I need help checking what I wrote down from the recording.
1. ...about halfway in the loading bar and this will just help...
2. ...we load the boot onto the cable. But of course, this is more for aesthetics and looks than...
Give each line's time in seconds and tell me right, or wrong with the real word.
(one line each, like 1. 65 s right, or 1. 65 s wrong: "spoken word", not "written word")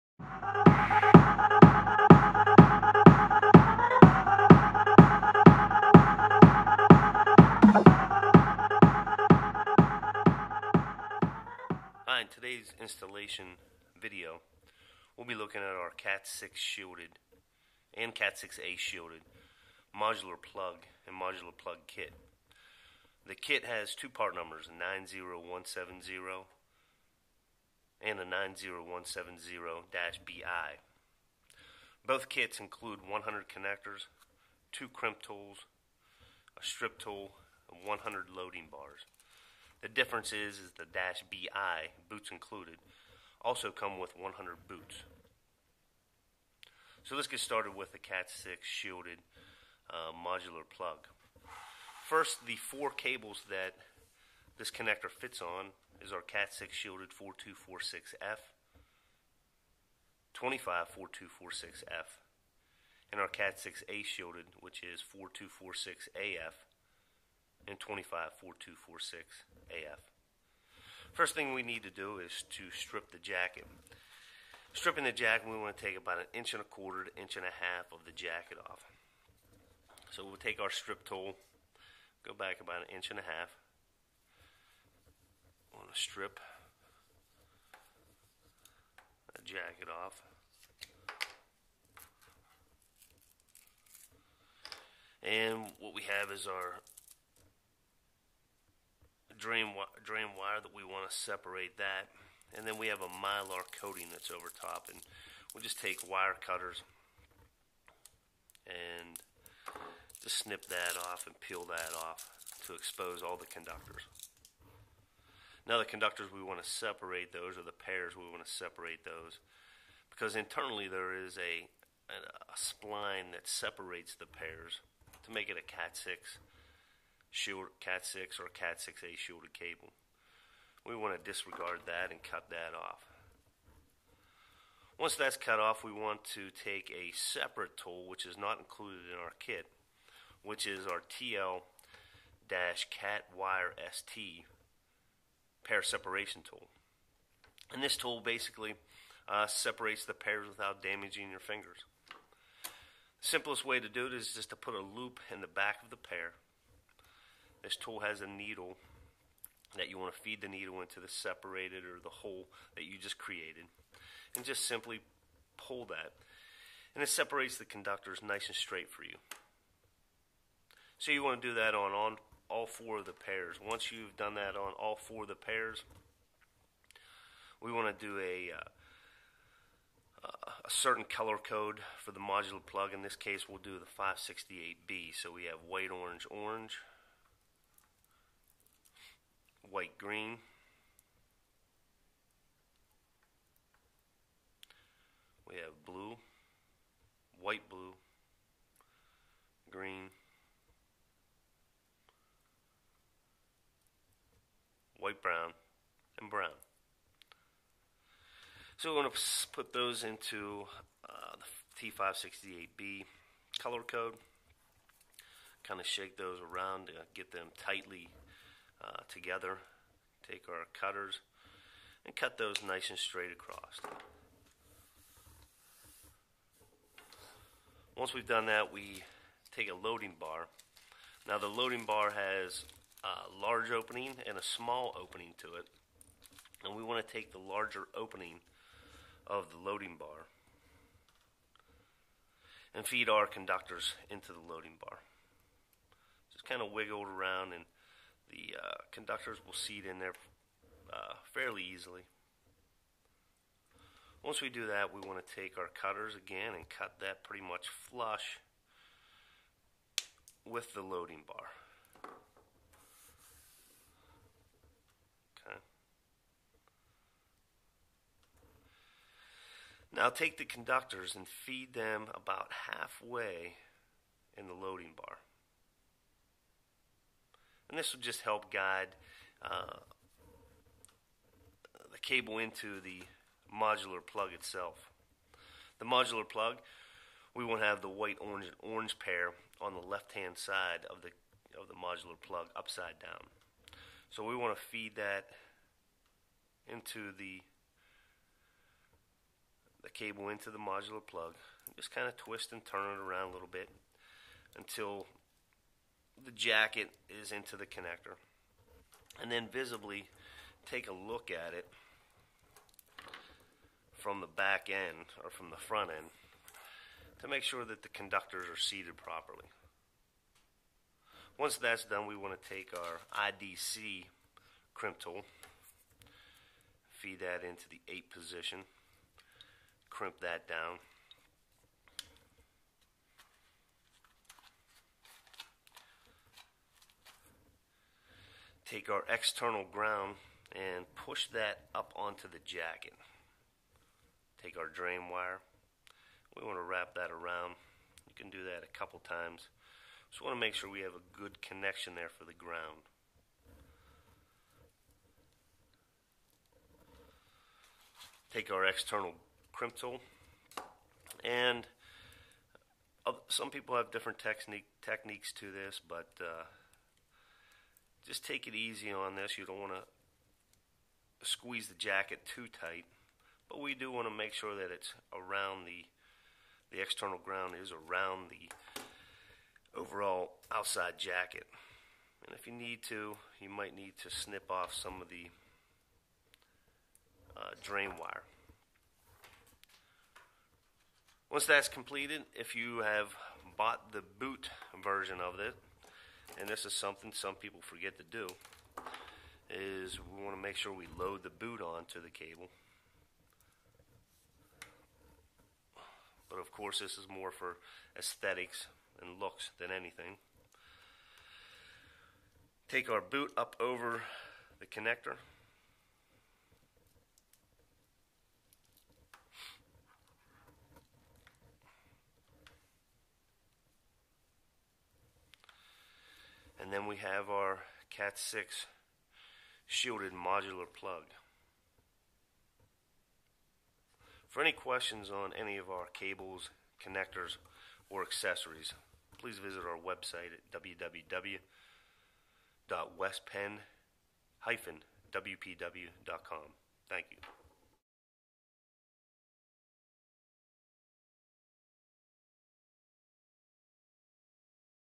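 1. 272 s right
2. 400 s right.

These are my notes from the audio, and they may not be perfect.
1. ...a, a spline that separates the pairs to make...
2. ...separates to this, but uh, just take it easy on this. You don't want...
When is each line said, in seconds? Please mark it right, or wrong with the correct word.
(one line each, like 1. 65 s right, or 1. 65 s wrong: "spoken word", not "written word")
1. 122 s right
2. 364 s wrong: "techniques", not "separates".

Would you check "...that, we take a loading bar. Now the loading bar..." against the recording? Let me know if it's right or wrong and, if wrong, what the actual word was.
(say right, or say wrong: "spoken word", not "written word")
right.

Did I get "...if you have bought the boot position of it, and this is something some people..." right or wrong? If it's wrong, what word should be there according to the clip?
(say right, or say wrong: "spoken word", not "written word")
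wrong: "version", not "position".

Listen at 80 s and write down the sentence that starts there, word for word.
So we'll take our strip tool, go back about an inch and a half want to strip jacket off.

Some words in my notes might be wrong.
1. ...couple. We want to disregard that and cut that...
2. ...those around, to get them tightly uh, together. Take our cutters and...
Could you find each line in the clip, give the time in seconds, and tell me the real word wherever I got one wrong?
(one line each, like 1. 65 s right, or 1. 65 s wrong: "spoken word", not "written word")
1. 129 s wrong: "cable", not "couple"
2. 216 s right.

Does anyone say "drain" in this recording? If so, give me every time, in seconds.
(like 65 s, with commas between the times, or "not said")
99 s, 344 s, 387 s.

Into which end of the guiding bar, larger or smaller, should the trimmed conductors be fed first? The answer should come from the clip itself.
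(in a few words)
larger opening.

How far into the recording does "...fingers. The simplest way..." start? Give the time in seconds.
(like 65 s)
151 s.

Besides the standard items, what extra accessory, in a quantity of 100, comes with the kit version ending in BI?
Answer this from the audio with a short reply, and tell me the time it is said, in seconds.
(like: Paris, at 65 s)
100 boots, at 44 s.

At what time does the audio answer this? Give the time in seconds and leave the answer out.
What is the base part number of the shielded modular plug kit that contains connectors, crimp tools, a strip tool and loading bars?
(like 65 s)
24 s.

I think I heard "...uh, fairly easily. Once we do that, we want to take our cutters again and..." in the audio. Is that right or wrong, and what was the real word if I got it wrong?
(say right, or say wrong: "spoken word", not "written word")
right.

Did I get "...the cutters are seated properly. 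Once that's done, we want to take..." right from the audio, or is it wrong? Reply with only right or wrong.
wrong.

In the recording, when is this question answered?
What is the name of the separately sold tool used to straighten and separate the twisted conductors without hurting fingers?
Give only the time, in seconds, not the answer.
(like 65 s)
141 s.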